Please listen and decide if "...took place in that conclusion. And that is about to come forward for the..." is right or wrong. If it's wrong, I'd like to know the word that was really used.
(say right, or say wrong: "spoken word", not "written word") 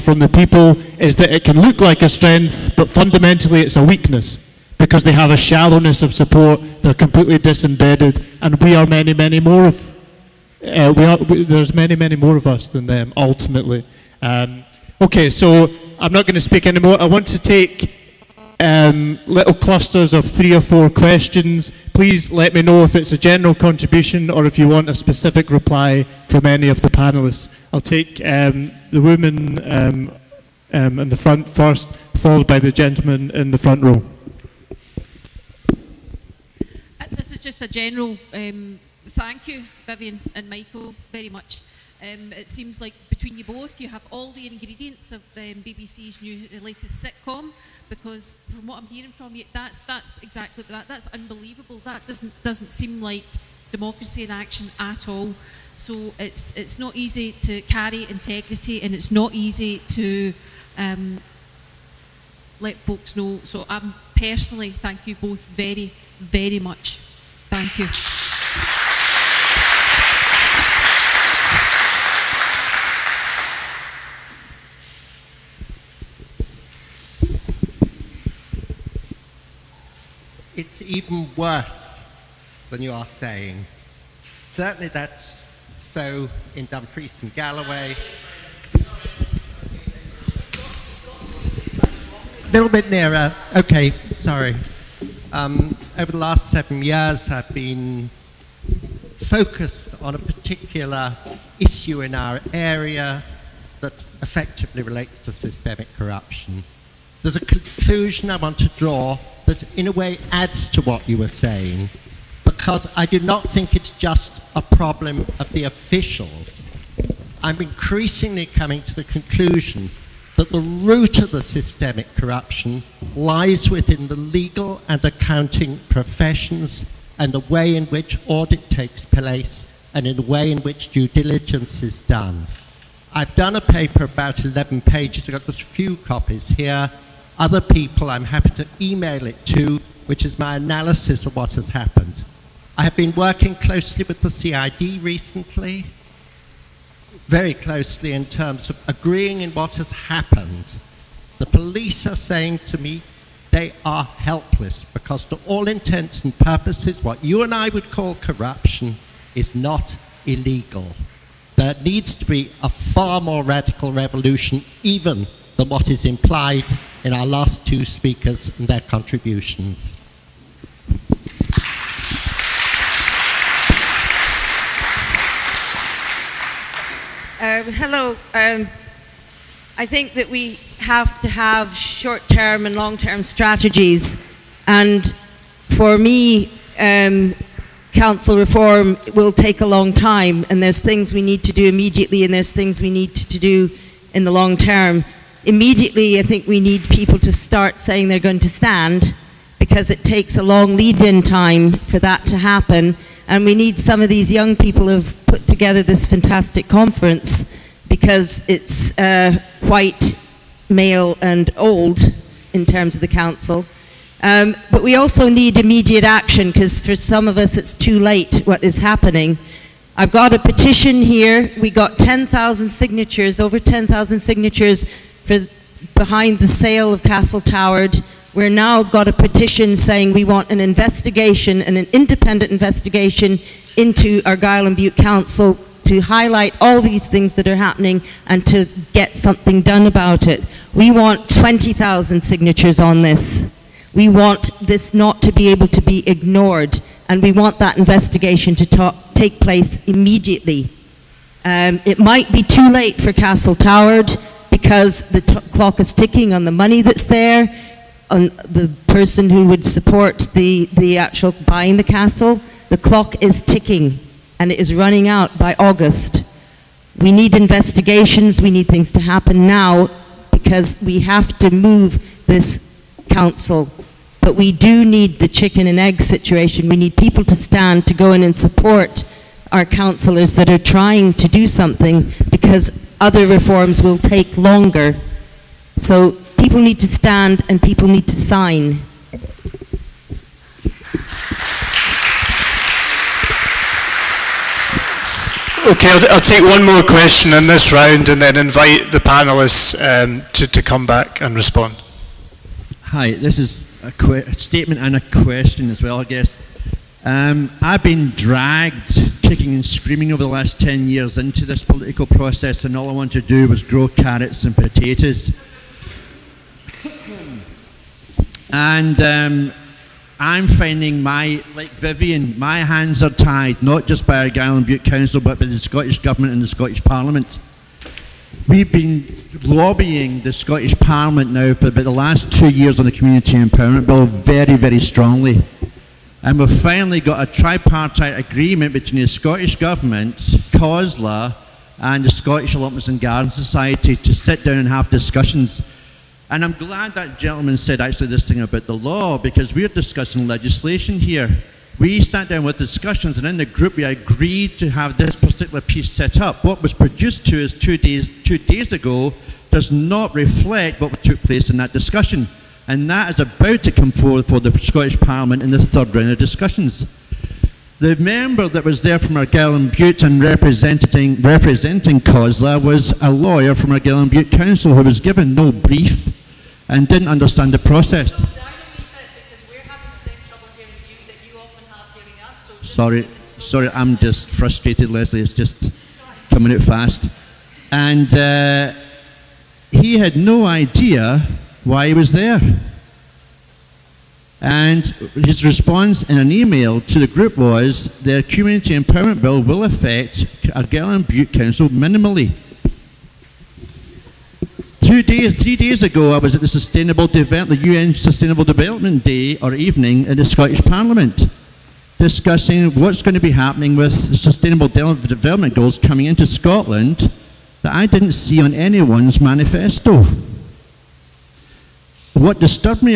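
wrong: "discussion", not "conclusion".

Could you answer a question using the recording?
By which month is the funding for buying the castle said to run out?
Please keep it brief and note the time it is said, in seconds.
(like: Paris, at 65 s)
August, at 265 s.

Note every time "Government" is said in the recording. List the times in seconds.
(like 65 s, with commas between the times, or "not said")
325 s, 339 s.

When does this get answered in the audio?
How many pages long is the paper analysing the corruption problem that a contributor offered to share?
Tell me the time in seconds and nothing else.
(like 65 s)
134 s.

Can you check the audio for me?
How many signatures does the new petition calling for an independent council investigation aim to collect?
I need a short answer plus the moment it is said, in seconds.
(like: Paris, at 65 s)
20,000, at 241 s.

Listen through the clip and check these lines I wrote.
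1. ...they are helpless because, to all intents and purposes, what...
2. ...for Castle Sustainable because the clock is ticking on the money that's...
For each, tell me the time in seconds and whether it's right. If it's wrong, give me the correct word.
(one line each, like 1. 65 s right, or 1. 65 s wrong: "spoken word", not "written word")
1. 153 s right
2. 252 s wrong: "Toward", not "Sustainable".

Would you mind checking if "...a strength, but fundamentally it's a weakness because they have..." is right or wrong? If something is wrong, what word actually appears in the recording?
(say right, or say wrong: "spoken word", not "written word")
right.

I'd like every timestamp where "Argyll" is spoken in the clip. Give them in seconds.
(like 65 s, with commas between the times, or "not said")
234 s, 324 s, 369 s, 373 s, 400 s.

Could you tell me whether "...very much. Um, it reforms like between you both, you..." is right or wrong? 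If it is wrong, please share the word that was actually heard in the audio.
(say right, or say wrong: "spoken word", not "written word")
wrong: "seems", not "reforms".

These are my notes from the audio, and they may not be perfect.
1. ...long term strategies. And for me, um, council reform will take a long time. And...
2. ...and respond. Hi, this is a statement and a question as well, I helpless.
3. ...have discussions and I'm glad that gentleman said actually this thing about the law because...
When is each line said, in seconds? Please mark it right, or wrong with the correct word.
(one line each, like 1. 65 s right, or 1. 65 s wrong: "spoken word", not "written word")
1. 182 s right
2. 301 s wrong: "guess", not "helpless"
3. 344 s right.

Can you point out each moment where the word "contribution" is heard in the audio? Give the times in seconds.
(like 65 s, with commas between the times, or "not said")
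23 s, 168 s.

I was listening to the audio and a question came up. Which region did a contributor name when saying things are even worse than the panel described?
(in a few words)
Dumfries and Galloway.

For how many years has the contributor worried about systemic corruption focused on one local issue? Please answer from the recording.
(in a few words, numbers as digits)
7.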